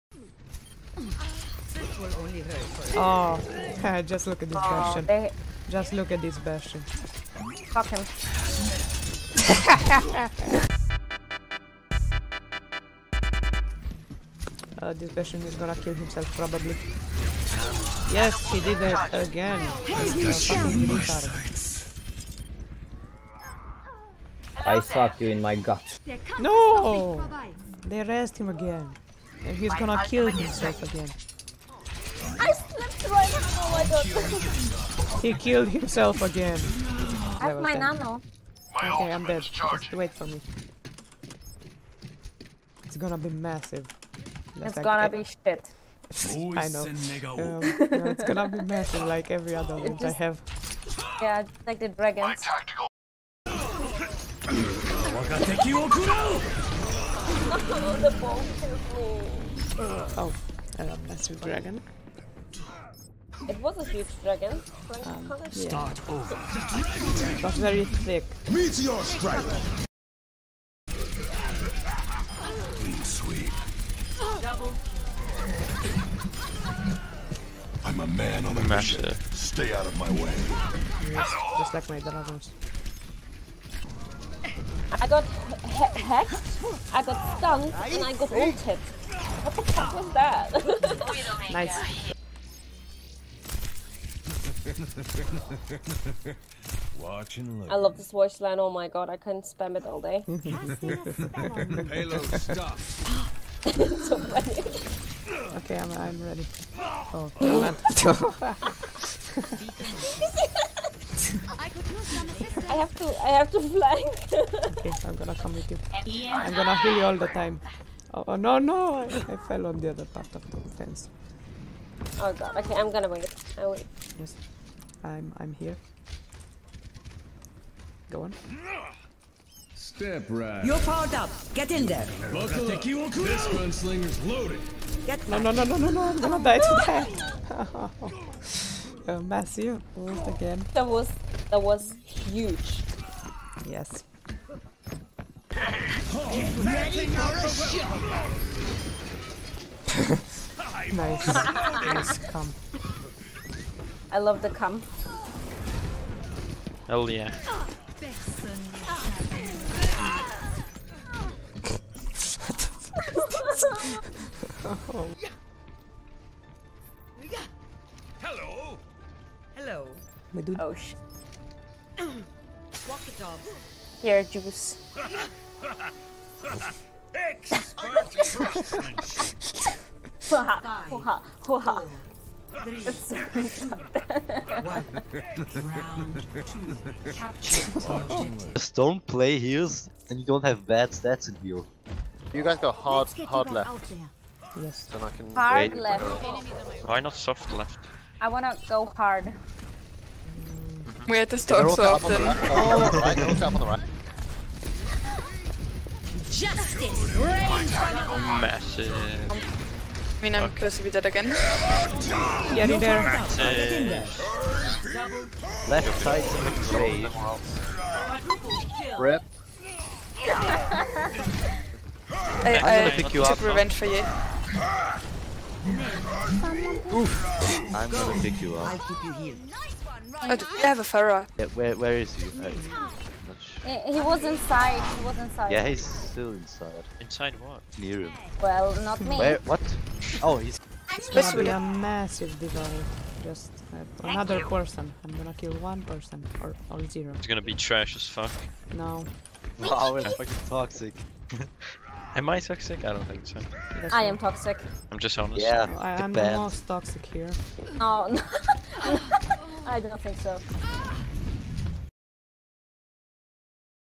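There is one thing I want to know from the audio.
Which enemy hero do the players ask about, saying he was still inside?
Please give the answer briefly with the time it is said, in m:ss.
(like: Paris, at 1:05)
Pharah, at 3:50.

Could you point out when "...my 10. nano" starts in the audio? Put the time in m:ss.
0:37.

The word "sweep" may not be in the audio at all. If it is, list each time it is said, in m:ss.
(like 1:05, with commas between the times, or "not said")
1:13.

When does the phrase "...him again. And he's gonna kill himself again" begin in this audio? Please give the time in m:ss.
0:28.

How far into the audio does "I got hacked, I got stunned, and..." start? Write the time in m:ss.
1:25.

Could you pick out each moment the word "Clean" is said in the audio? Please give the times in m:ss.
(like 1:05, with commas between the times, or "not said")
1:12.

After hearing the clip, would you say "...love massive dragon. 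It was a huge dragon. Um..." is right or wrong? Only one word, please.
right.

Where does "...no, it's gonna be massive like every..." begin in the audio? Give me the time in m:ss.
0:47.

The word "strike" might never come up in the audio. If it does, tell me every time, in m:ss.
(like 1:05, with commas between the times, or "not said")
1:09.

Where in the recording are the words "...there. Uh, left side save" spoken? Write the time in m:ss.
3:32.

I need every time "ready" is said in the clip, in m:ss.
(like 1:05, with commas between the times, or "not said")
1:46, 2:26.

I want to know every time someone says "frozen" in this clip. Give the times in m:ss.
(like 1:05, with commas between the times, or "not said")
not said.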